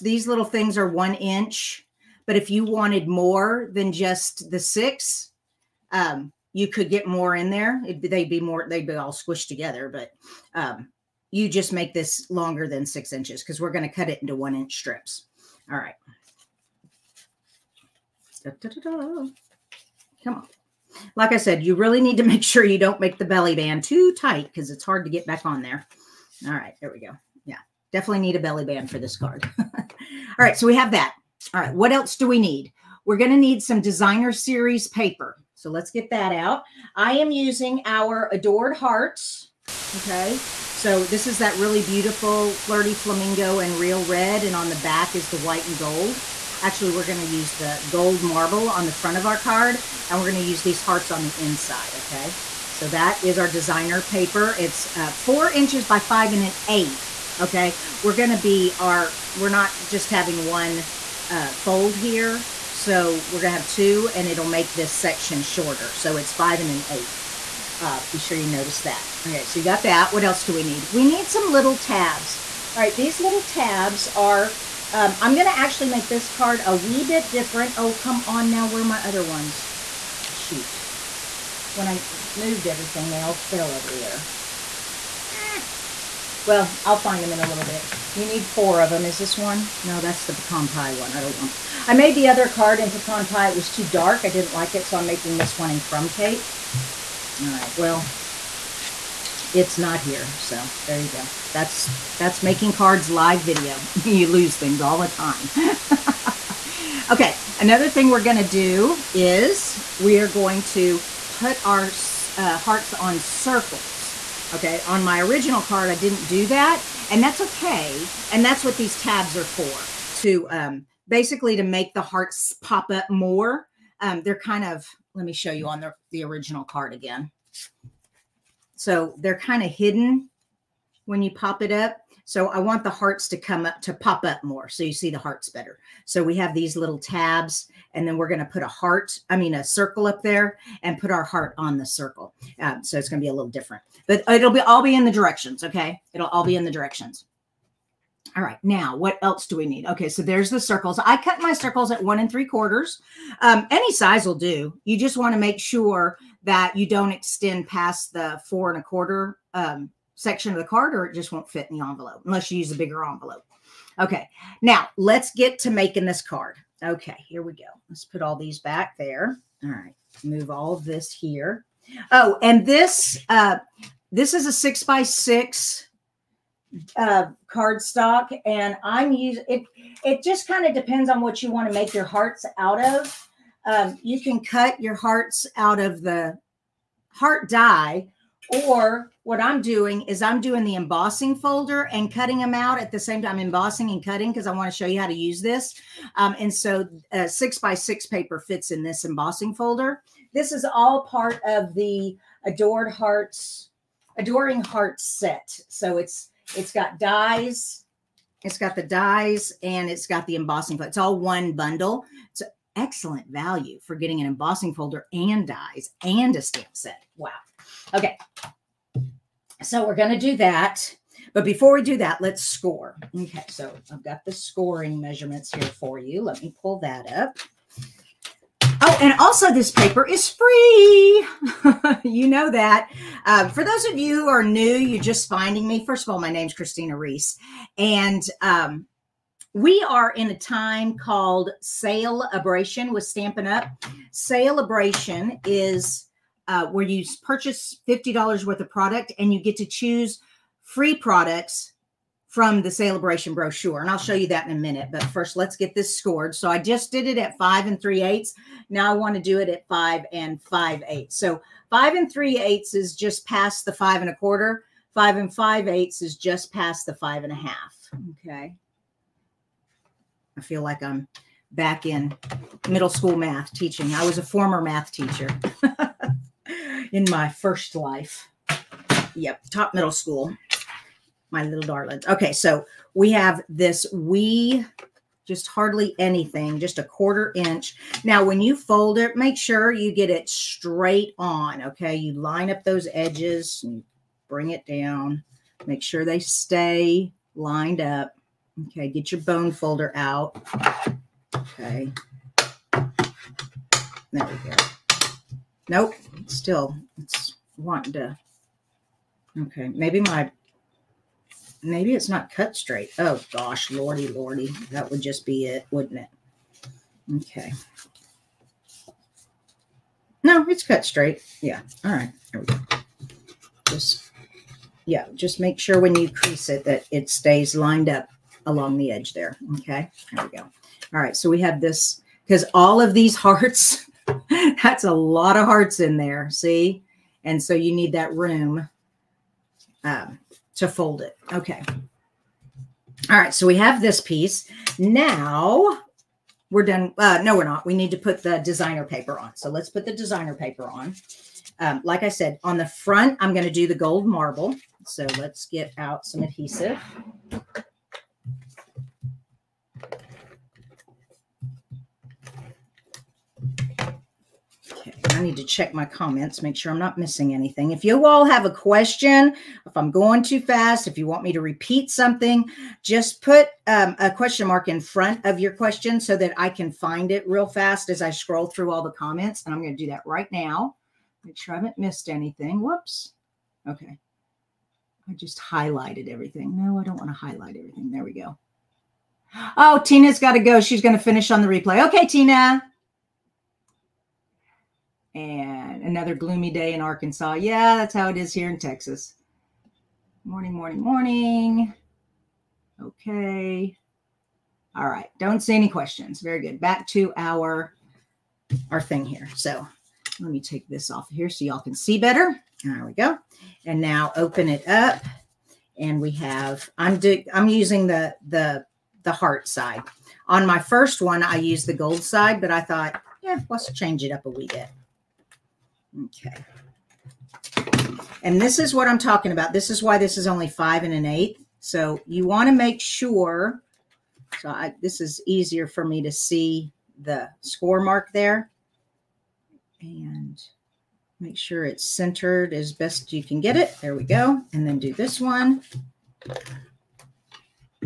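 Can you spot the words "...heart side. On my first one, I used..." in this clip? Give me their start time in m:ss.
6:59.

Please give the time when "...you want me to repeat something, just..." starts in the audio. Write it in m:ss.
6:10.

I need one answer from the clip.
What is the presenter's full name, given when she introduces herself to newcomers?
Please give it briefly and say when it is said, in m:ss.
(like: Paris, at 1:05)
Kristina Rees, at 3:56.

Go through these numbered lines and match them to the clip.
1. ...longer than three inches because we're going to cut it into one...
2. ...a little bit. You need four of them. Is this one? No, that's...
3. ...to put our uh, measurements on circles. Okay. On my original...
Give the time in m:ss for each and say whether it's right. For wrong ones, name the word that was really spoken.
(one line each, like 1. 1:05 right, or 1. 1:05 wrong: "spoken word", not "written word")
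1. 0:12 wrong: "six", not "three"
2. 1:27 right
3. 1:50 wrong: "hearts", not "measurements".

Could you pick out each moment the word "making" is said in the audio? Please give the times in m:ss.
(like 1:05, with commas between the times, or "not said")
1:35, 1:42, 2:45.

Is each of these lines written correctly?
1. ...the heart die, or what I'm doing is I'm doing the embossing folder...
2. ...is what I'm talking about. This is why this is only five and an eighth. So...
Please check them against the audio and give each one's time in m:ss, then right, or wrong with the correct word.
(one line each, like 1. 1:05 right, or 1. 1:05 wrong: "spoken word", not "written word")
1. 3:06 right
2. 7:08 right.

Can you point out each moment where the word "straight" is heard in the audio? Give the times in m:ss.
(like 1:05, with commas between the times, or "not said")
4:50, 5:12, 5:20.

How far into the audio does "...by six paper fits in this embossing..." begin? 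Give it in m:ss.
3:17.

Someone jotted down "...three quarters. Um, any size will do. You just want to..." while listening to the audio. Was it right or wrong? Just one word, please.
right.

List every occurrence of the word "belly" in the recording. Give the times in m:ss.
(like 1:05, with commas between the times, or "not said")
0:23, 0:28.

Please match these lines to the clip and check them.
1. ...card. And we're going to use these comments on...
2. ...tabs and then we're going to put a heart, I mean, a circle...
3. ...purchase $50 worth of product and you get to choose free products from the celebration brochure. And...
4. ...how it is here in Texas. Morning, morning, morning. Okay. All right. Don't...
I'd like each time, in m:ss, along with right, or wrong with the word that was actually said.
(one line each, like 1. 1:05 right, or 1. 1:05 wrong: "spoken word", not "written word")
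1. 0:49 wrong: "hearts", not "comments"
2. 2:16 right
3. 4:07 right
4. 6:37 right.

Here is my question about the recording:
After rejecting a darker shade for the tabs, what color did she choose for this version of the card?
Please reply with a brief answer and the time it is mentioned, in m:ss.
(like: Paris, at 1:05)
crumb cake, at 1:35.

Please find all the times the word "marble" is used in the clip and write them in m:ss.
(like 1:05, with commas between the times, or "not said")
0:48, 5:54.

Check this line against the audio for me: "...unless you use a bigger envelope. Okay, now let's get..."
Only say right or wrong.
right.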